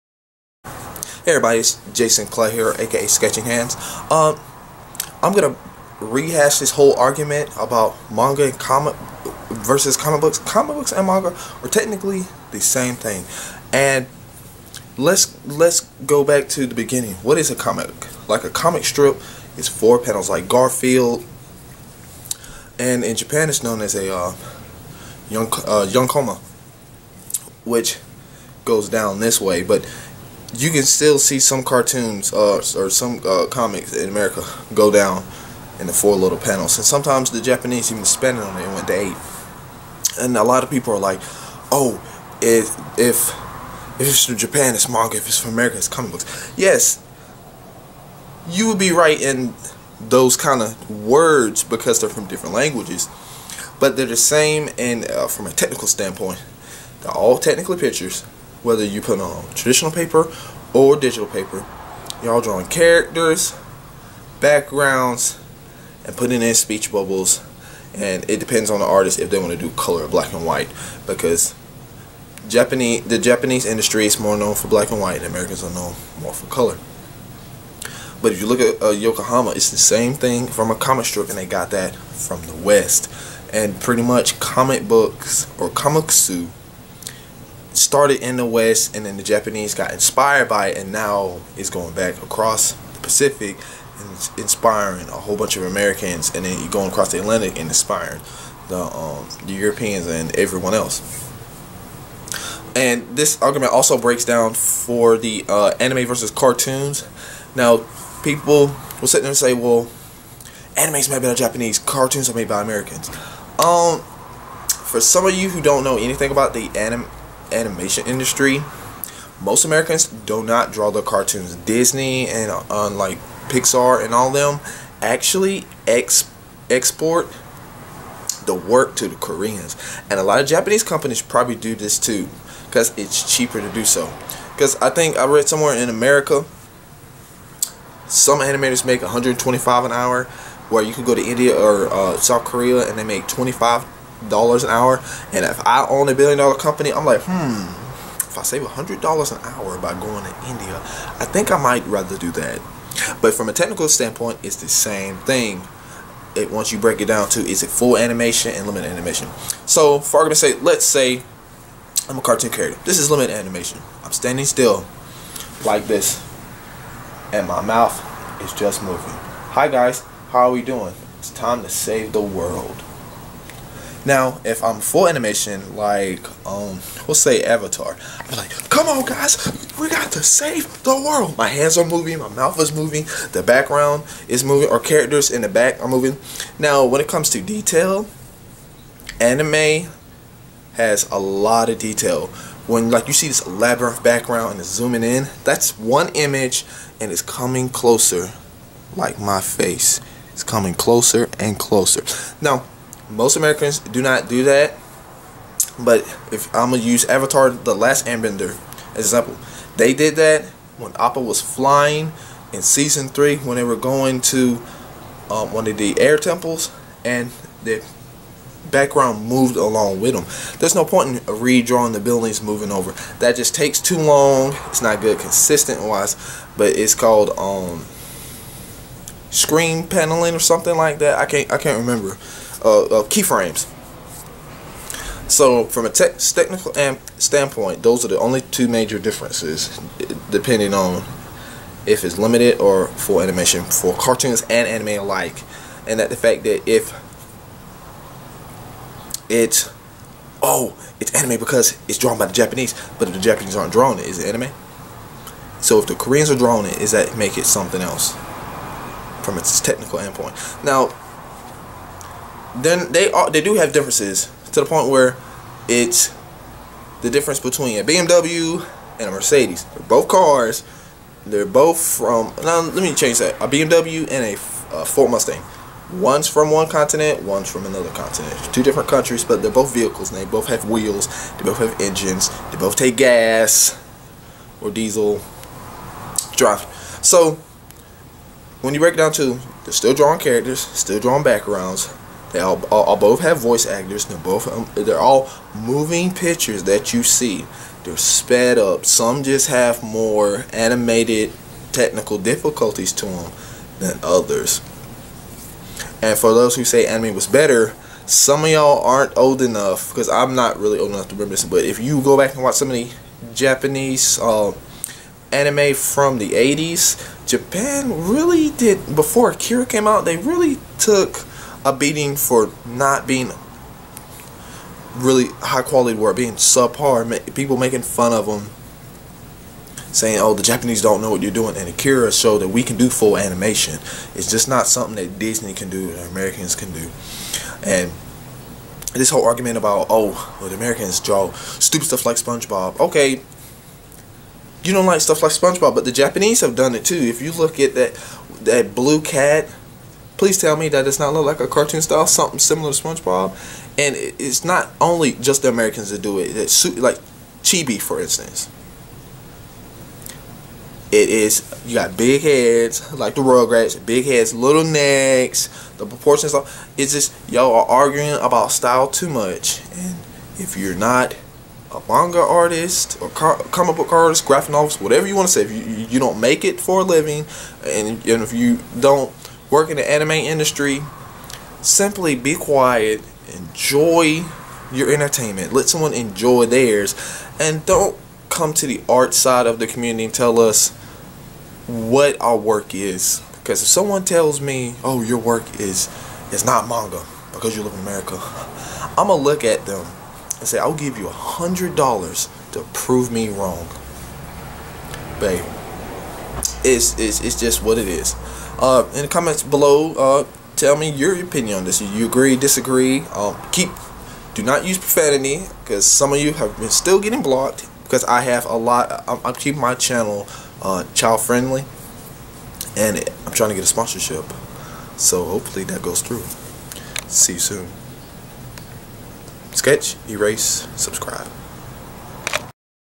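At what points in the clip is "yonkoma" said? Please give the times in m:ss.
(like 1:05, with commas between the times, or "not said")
0:25, 1:18.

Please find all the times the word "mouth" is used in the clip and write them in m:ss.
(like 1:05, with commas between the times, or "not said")
2:47, 3:02.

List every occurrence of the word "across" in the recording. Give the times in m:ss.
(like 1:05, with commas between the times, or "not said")
1:32, 1:36.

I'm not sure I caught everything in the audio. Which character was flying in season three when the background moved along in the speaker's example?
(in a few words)
Appa.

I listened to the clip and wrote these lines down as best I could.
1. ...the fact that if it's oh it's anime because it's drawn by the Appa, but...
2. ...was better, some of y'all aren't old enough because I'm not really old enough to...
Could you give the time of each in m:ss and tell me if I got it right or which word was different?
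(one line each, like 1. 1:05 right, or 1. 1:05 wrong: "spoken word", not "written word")
1. 4:06 wrong: "Japanese", not "Appa"
2. 5:07 right.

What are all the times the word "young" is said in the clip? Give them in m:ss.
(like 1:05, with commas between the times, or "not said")
0:25.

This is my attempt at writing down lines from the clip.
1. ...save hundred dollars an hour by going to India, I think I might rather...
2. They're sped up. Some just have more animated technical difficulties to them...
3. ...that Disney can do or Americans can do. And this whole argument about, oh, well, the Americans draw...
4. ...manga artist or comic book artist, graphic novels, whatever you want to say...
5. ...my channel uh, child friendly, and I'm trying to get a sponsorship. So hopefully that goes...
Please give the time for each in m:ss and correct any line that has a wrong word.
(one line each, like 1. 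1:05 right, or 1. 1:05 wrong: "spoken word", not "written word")
1. 2:28 right
2. 4:57 right
3. 5:34 right
4. 6:11 right
5. 6:59 right.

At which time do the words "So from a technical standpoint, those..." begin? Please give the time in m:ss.
3:55.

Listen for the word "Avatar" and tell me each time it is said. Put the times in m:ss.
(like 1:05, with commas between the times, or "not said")
2:57, 3:27.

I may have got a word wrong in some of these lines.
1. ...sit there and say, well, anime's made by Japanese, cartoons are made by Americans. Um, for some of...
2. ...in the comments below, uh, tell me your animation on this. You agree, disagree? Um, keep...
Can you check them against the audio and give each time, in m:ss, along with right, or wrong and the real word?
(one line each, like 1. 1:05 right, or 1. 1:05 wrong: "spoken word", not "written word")
1. 1:49 right
2. 6:48 wrong: "opinion", not "animation".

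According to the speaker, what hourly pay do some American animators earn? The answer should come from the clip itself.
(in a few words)
$125.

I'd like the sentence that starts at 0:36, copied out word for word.
And sometimes the Japanese even it on it and went to eight.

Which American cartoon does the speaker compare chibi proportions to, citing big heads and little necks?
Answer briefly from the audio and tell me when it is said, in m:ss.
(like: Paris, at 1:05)
Rugrats, at 6:03.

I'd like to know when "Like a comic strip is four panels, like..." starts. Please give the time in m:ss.
0:18.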